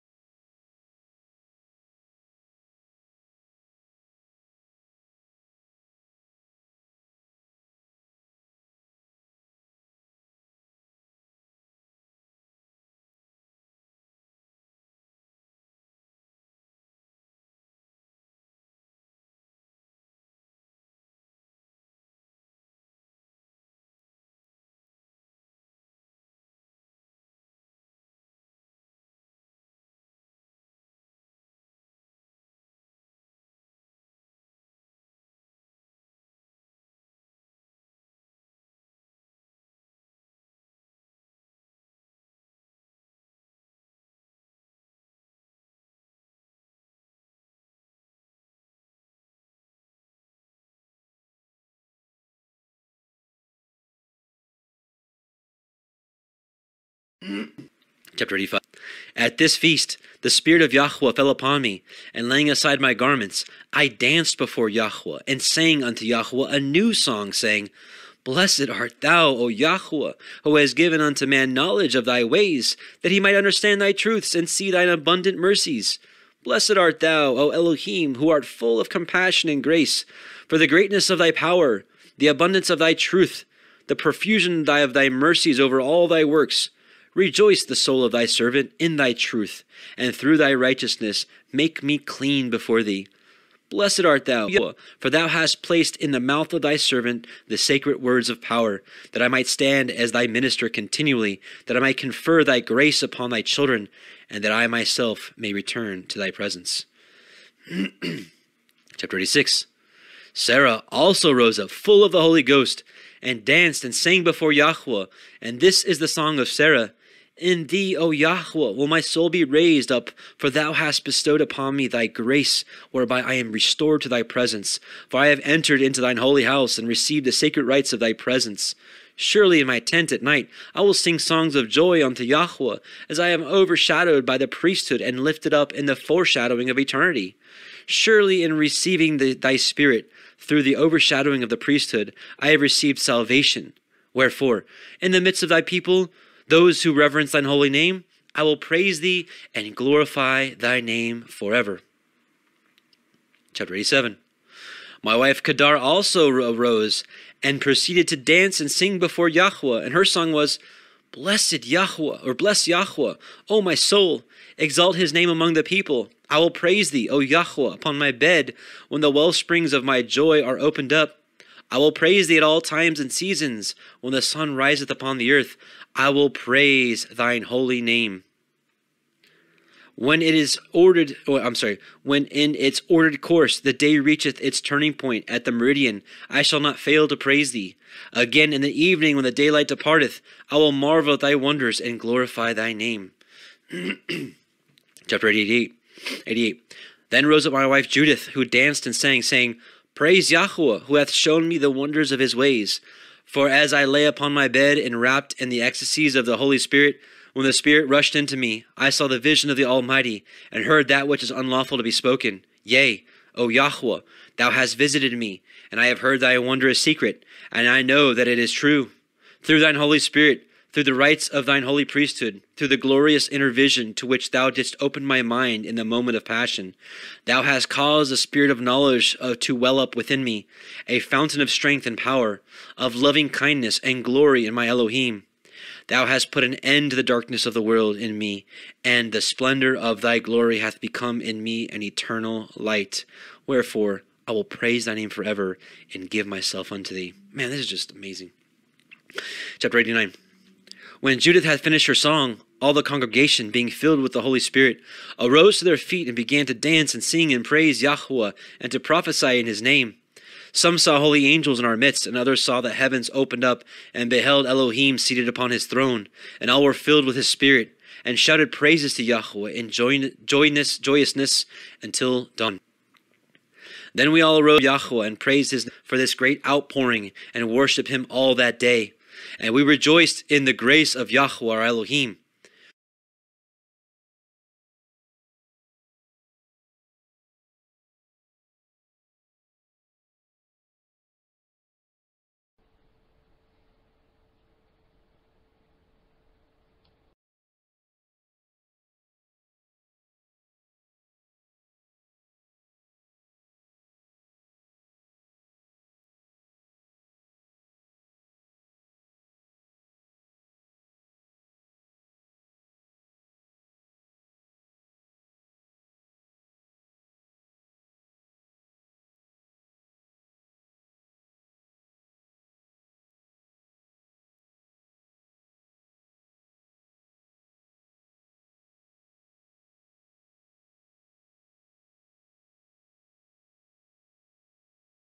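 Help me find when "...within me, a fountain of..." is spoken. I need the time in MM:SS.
03:49.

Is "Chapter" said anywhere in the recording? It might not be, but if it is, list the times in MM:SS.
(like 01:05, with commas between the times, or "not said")
00:58, 01:48, 02:33, 03:15, 04:09.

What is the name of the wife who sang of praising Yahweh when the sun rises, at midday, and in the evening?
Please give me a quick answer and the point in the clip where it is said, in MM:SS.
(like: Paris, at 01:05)
Kadara, at 02:35.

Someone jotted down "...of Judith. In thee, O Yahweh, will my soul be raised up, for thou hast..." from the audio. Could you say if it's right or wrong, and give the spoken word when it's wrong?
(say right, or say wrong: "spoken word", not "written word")
wrong: "Sarah", not "Judith".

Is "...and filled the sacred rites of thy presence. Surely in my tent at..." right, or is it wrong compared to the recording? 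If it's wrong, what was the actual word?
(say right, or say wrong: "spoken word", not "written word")
wrong: "received", not "filled".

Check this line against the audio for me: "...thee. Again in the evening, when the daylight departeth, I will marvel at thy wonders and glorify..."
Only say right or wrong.
right.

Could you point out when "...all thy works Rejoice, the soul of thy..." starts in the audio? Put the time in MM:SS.
01:25.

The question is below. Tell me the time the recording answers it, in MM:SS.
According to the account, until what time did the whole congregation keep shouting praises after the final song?
04:31.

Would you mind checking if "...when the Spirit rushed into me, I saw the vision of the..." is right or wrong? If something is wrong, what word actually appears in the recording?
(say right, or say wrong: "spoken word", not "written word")
right.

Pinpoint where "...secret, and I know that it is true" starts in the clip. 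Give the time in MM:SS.
03:36.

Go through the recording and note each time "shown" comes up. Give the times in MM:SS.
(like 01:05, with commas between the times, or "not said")
03:21.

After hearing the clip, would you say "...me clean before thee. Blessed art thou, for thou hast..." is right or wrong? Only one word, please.
right.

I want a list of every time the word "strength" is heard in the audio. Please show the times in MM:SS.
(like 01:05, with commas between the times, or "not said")
03:51.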